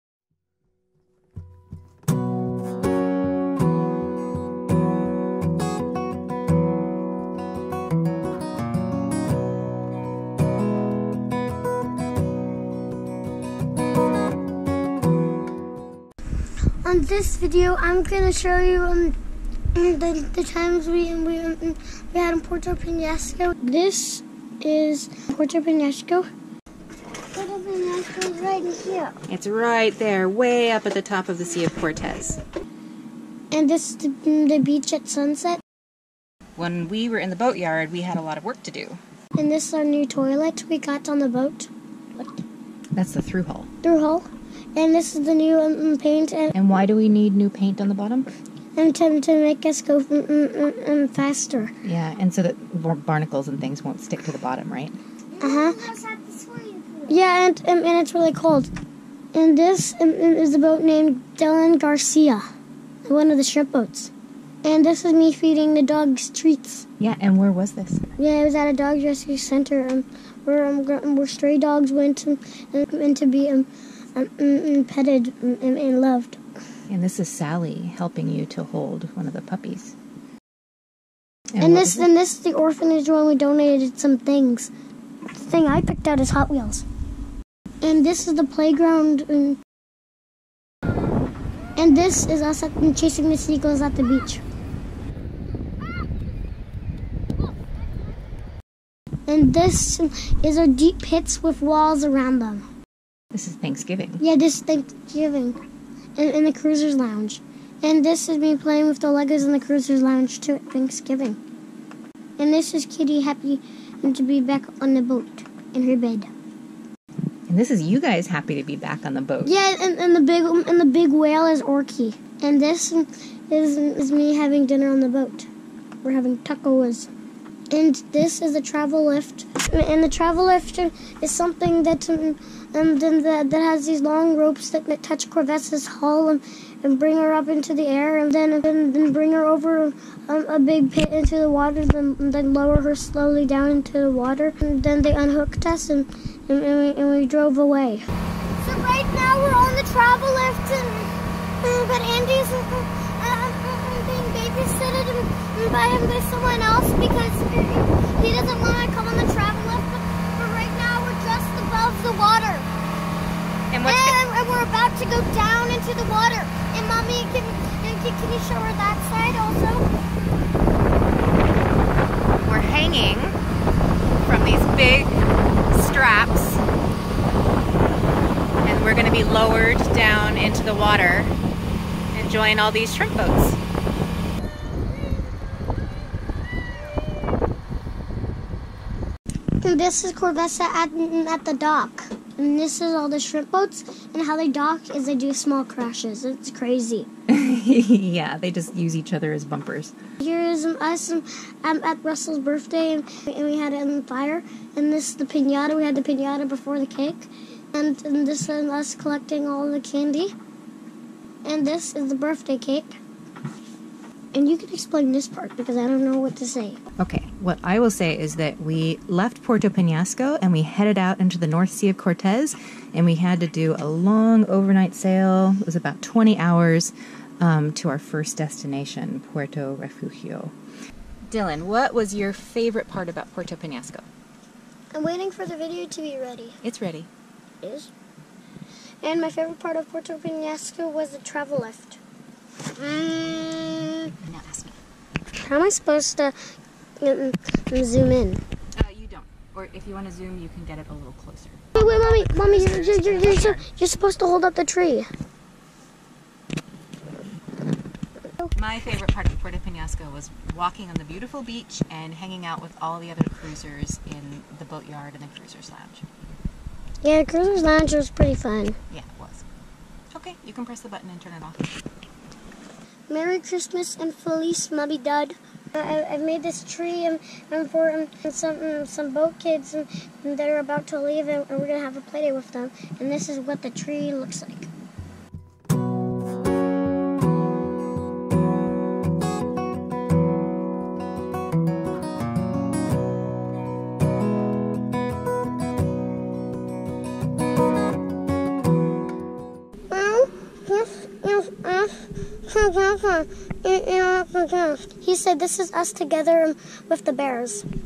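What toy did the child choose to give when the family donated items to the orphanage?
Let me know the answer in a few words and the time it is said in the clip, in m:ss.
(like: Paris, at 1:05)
Hot Wheels, at 1:26.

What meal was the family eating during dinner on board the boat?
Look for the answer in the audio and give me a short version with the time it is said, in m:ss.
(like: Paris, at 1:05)
Tacos, at 2:06.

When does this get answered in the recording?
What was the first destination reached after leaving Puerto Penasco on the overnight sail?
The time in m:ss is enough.
3:49.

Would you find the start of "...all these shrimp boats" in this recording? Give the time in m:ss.
3:02.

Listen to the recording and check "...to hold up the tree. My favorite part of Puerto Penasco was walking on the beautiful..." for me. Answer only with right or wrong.
right.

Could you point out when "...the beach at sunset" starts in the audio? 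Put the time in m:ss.
0:34.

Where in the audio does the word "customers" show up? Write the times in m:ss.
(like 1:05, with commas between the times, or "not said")
not said.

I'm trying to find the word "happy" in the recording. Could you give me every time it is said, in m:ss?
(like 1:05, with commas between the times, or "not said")
1:53, 1:58.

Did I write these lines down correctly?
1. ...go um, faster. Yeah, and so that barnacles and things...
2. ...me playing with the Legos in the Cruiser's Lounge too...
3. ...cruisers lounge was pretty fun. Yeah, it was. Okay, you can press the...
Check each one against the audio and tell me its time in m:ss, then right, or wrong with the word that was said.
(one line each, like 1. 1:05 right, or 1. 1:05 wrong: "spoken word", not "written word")
1. 0:49 right
2. 1:48 right
3. 4:27 right.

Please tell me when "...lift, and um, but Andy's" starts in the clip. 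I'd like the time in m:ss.
2:30.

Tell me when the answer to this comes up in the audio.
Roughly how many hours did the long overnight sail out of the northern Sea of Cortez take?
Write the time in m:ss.
3:46.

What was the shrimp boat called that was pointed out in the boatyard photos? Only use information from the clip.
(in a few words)
Dylan Garcia.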